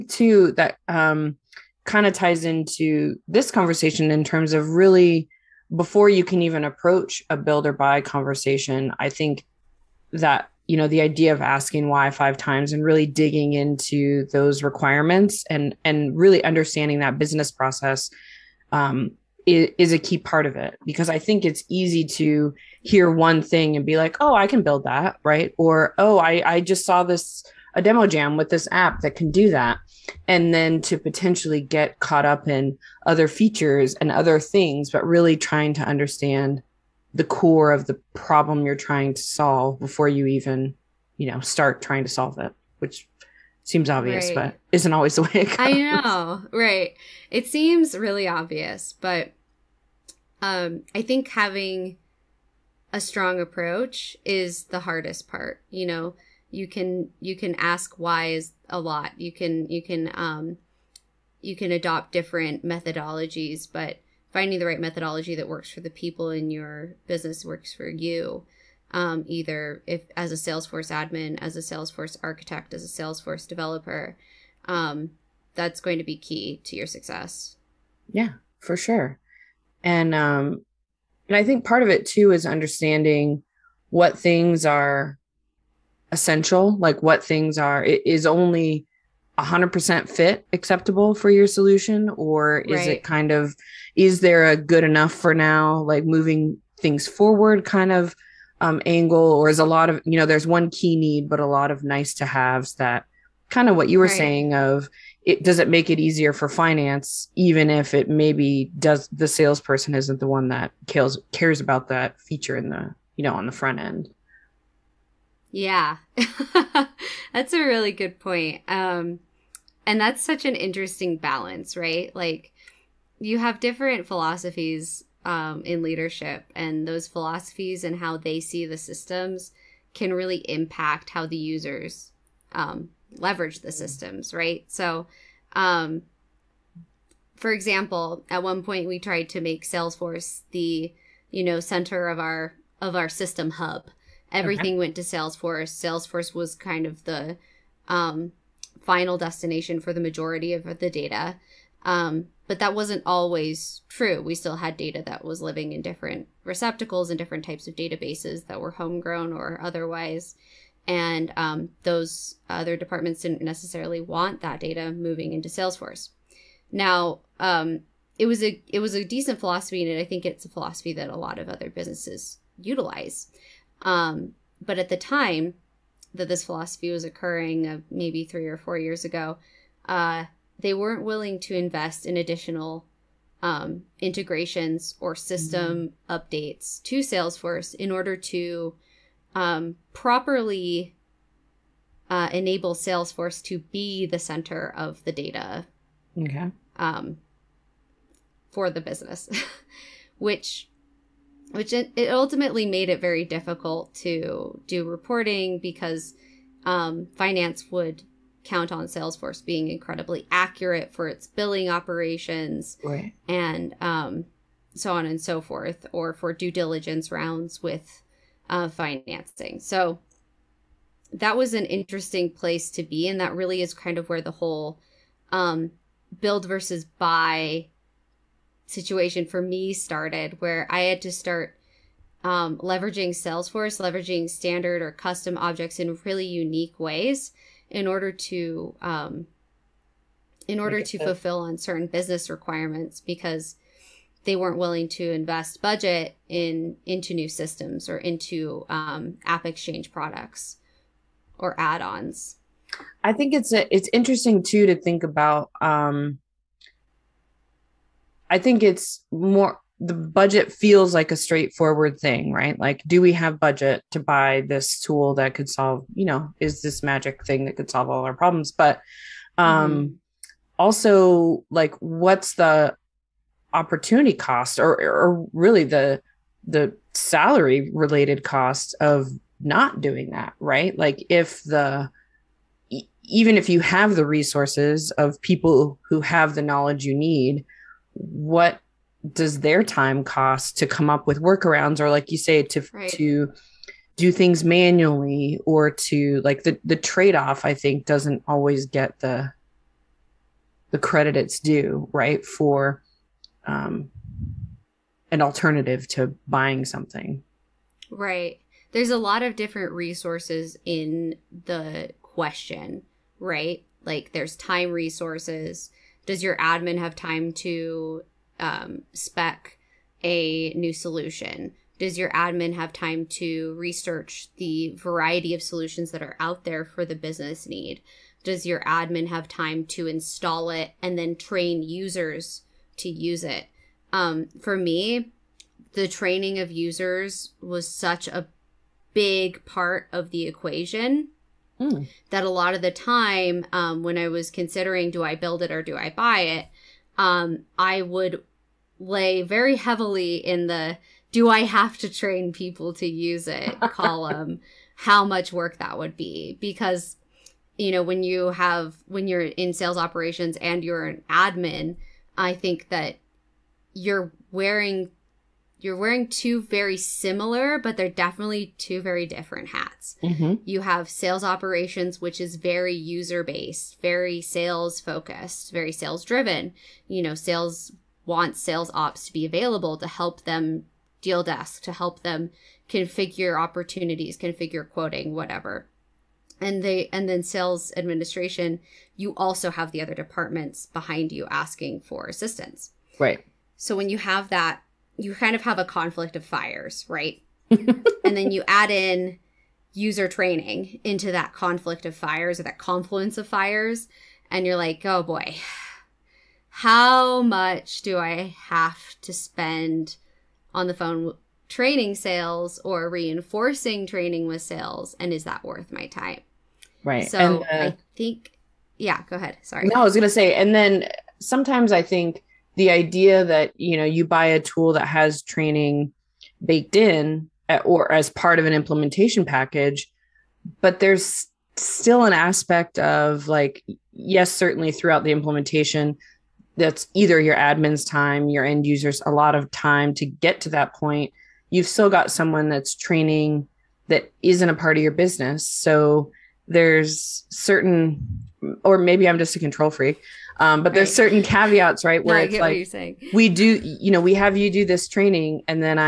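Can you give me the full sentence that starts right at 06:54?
And is that worth my time?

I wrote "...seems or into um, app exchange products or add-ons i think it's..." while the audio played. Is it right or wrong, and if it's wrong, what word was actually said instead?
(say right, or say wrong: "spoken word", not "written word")
wrong: "systems", not "seems".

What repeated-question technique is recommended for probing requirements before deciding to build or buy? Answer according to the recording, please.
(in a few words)
asking why five times.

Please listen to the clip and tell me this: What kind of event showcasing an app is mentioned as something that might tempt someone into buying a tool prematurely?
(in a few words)
demo jam.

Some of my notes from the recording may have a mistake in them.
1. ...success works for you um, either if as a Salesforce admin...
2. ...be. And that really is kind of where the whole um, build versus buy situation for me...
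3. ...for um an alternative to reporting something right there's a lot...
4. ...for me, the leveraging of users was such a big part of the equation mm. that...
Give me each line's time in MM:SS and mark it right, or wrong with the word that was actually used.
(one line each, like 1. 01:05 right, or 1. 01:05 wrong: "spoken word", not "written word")
1. 01:07 wrong: "business", not "success"
2. 03:42 right
3. 05:02 wrong: "buying", not "reporting"
4. 05:34 wrong: "training", not "leveraging".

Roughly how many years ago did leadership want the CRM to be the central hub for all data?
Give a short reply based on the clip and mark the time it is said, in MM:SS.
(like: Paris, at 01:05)
3 or 4 years, at 02:58.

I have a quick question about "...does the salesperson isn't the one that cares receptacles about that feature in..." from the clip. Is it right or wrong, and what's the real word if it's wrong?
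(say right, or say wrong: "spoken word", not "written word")
wrong: "cares", not "receptacles".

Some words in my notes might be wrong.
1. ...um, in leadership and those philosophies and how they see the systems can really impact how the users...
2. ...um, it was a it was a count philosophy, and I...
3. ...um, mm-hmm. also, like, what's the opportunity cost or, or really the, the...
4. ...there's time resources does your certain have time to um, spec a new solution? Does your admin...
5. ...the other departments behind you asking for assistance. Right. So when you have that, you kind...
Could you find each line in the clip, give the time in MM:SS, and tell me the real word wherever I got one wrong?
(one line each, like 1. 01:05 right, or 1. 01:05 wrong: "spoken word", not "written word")
1. 02:05 right
2. 02:47 wrong: "decent", not "count"
3. 04:29 right
4. 05:14 wrong: "admin", not "certain"
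5. 06:29 right.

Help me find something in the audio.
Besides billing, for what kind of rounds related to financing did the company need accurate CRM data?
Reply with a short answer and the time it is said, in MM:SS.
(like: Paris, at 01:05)
due diligence rounds, at 03:36.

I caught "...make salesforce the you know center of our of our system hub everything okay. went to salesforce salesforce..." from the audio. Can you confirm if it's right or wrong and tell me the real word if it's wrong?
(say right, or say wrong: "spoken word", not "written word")
right.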